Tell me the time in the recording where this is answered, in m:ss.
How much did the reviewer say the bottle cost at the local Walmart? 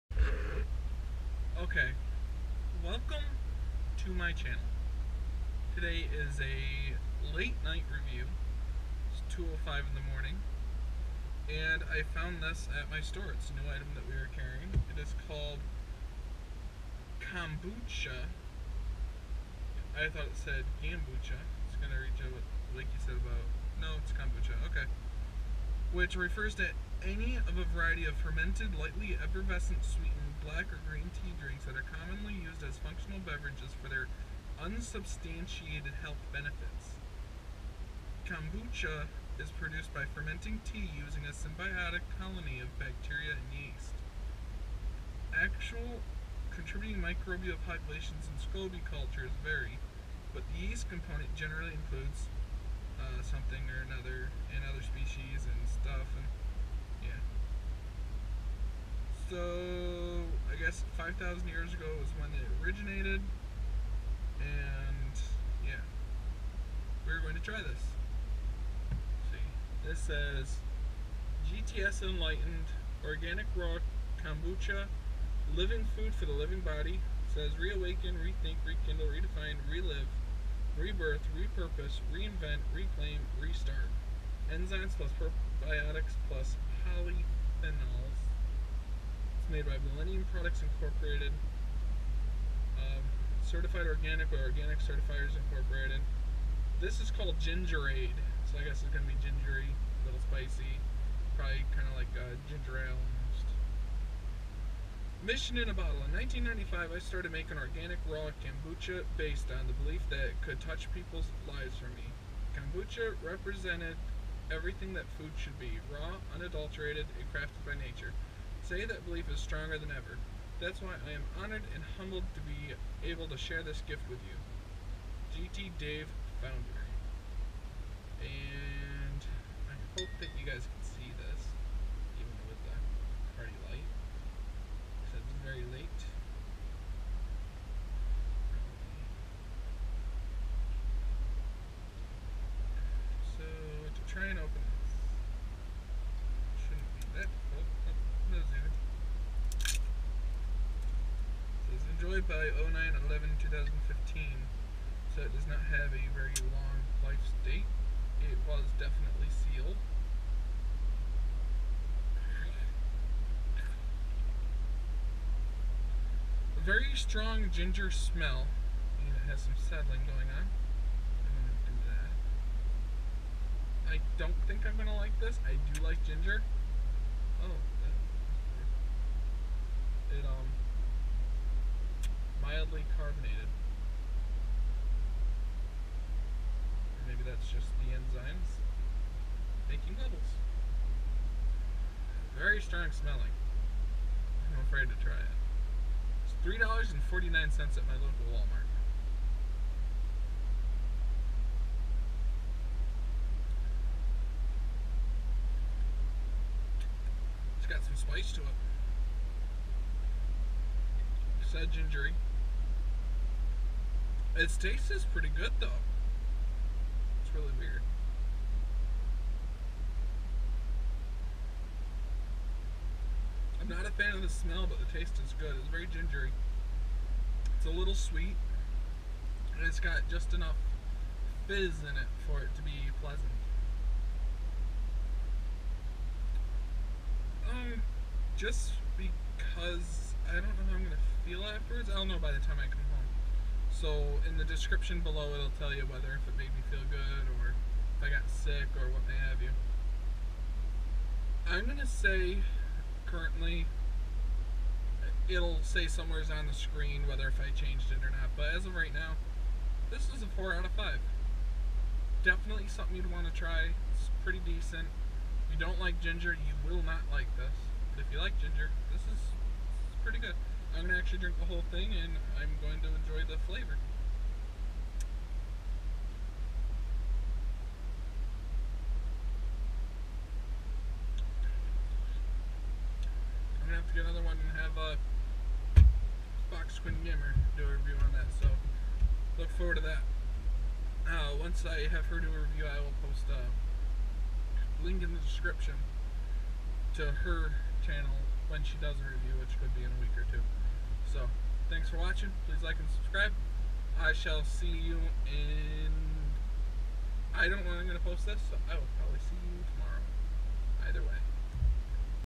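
3:16.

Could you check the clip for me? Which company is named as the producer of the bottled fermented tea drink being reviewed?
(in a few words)
Millennium Products Incorporated.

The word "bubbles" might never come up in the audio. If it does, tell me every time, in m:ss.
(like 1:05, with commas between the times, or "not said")
3:09.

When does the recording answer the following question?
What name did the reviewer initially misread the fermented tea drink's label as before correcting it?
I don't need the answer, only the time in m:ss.
0:20.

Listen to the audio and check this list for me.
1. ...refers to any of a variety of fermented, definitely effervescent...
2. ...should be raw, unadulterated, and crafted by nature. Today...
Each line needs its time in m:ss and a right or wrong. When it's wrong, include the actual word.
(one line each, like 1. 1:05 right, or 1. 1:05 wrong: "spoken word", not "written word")
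1. 0:26 wrong: "lightly", not "definitely"
2. 1:55 right.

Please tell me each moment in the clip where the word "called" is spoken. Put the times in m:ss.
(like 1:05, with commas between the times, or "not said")
0:15, 1:37.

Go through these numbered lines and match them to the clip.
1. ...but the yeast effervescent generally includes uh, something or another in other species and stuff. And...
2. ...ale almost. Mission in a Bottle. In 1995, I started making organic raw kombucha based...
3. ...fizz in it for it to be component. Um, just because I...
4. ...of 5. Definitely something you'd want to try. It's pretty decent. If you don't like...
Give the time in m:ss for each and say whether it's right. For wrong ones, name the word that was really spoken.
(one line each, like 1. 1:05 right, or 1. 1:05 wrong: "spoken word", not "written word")
1. 0:50 wrong: "component", not "effervescent"
2. 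1:42 right
3. 3:51 wrong: "pleasant", not "component"
4. 4:20 right.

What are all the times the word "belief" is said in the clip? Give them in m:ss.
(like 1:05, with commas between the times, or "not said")
1:49, 1:59.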